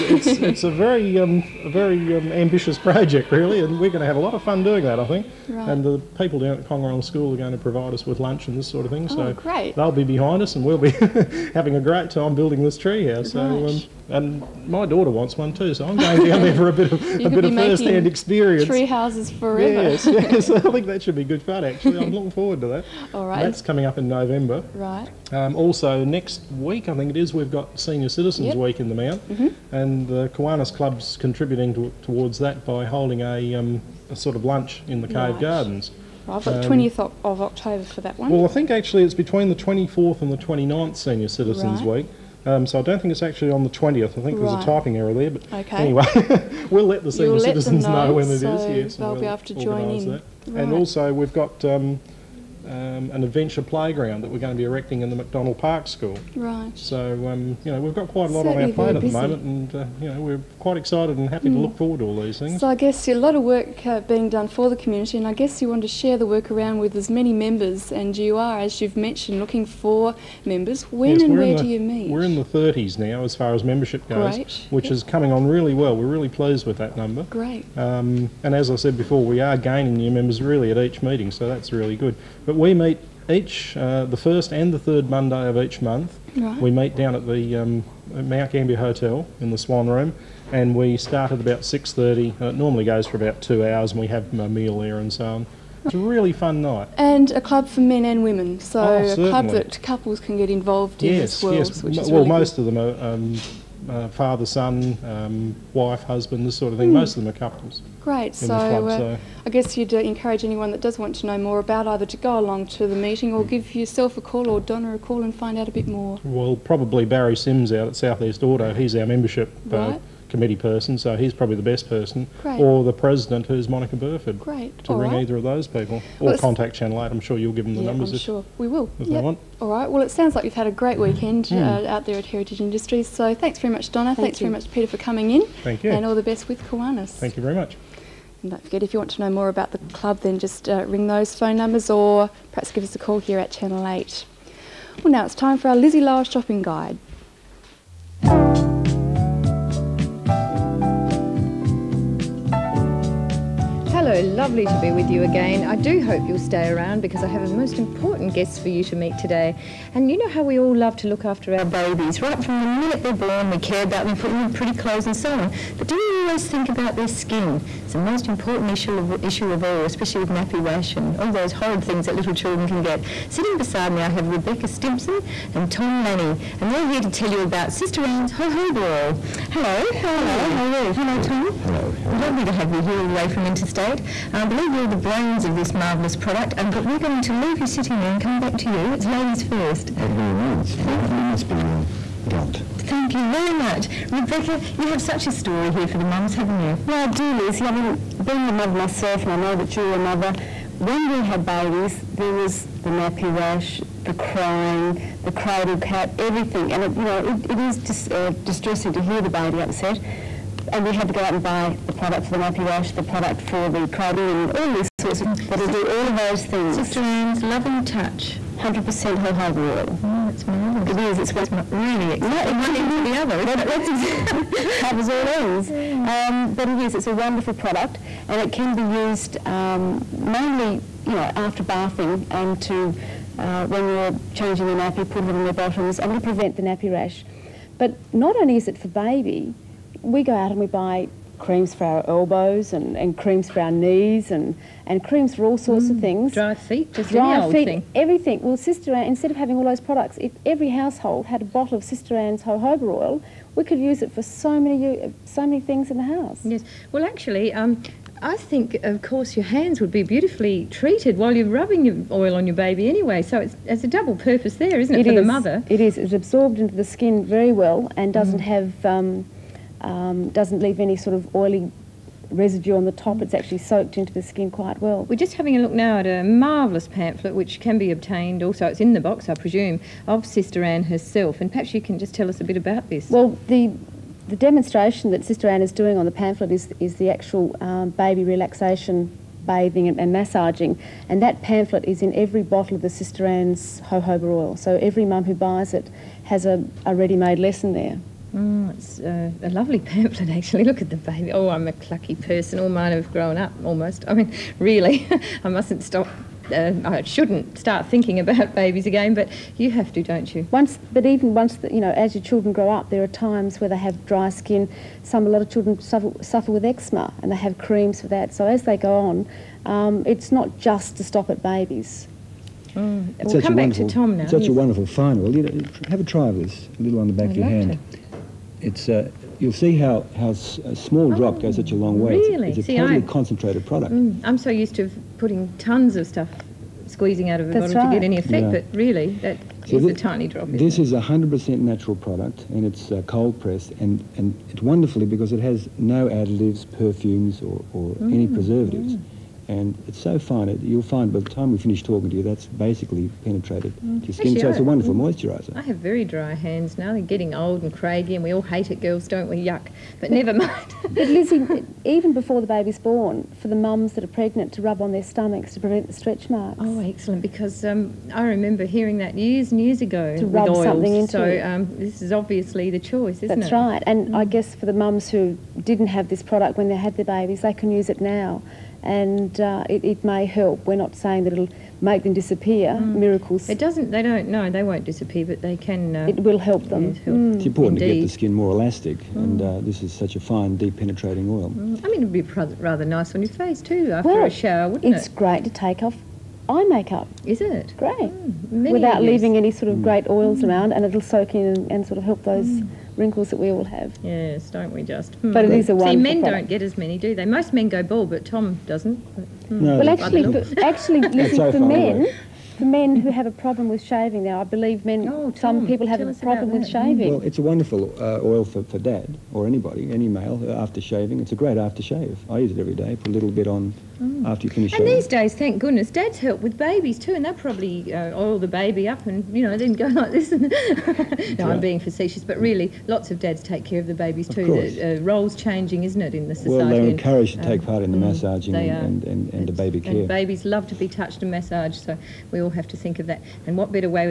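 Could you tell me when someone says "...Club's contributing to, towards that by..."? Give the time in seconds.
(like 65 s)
30 s.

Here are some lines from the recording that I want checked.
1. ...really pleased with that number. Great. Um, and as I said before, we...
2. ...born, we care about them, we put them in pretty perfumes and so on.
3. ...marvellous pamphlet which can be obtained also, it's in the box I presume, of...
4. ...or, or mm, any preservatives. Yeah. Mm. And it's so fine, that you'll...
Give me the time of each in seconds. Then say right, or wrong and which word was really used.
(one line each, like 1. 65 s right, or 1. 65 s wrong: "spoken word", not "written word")
1. 76 s right
2. 163 s wrong: "clothes", not "perfumes"
3. 276 s right
4. 347 s right.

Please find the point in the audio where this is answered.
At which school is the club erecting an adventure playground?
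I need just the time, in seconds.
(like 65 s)
55 s.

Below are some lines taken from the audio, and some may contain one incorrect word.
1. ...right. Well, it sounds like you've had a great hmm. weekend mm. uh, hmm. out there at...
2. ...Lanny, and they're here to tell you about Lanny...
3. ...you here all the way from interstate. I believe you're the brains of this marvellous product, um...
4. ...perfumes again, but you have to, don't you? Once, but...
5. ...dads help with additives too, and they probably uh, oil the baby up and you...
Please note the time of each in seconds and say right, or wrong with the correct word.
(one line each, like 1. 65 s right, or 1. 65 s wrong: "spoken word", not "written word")
1. 129 s right
2. 176 s wrong: "Sister", not "Lanny"
3. 182 s right
4. 308 s wrong: "babies", not "perfumes"
5. 425 s wrong: "babies", not "additives".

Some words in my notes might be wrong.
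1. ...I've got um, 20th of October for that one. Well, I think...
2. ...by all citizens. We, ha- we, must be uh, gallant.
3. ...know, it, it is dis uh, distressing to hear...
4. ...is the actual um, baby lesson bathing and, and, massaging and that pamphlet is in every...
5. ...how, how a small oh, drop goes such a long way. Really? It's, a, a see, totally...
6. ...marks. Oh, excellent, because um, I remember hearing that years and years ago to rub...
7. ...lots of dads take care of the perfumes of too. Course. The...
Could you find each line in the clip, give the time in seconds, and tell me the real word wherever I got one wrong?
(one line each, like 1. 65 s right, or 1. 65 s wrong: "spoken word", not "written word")
1. 36 s right
2. 190 s wrong: "means", not "citizens"
3. 207 s right
4. 286 s wrong: "relaxation", not "lesson"
5. 329 s right
6. 366 s right
7. 432 s wrong: "babies", not "perfumes".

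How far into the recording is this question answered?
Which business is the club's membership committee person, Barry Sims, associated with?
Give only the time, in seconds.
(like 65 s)
117 s.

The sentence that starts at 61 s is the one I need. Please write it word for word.
to look forward to all these things.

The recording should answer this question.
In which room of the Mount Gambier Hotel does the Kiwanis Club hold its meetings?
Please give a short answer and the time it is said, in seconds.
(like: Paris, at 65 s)
Swan Room, at 89 s.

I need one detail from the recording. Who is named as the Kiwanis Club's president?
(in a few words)
Monica Burford.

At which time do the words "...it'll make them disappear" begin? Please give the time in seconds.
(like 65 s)
381 s.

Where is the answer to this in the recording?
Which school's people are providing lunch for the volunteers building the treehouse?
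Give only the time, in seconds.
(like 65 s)
6 s.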